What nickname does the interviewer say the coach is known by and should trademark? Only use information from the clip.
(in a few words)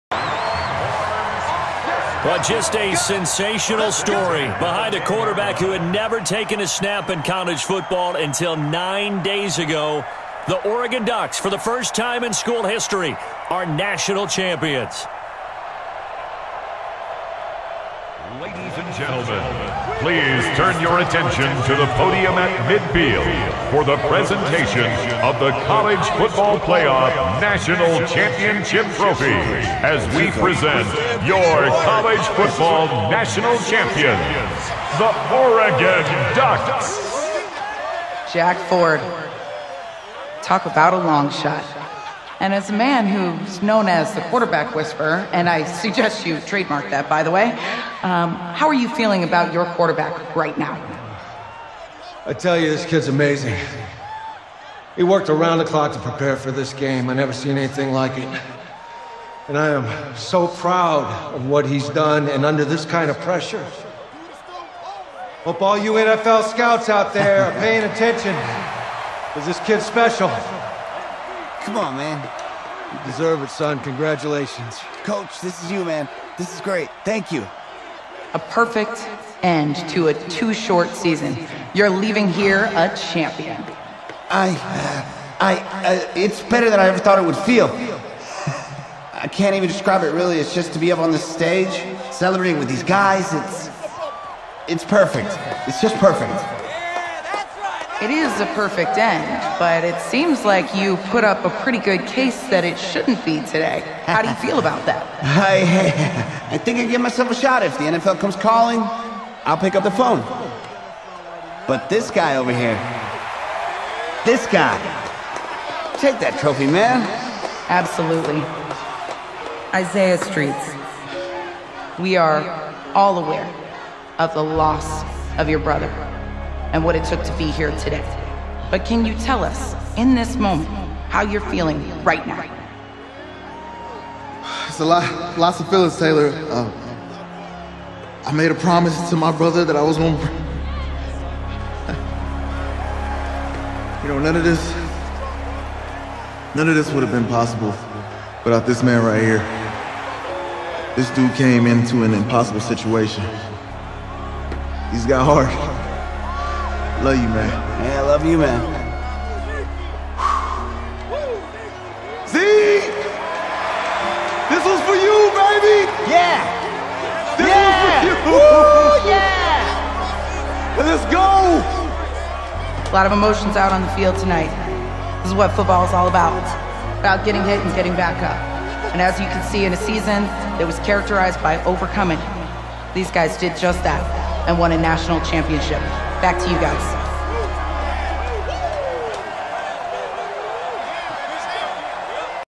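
quarterback whisperer.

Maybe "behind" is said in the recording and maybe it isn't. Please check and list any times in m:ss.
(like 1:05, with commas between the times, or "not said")
0:04.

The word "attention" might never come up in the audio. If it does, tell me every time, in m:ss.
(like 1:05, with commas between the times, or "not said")
0:20, 1:07.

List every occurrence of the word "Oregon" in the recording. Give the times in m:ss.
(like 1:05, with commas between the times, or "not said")
0:10, 0:35.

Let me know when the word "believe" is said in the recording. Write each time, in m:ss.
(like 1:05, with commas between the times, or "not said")
not said.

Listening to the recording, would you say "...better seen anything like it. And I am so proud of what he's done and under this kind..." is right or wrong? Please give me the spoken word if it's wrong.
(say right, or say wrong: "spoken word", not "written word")
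wrong: "never", not "better".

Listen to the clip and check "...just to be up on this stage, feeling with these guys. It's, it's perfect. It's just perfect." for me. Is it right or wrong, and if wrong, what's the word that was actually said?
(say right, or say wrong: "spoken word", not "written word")
wrong: "celebrating", not "feeling".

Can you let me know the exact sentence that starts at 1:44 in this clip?
How do you feel about that?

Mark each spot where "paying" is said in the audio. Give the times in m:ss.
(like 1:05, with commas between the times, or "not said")
1:07.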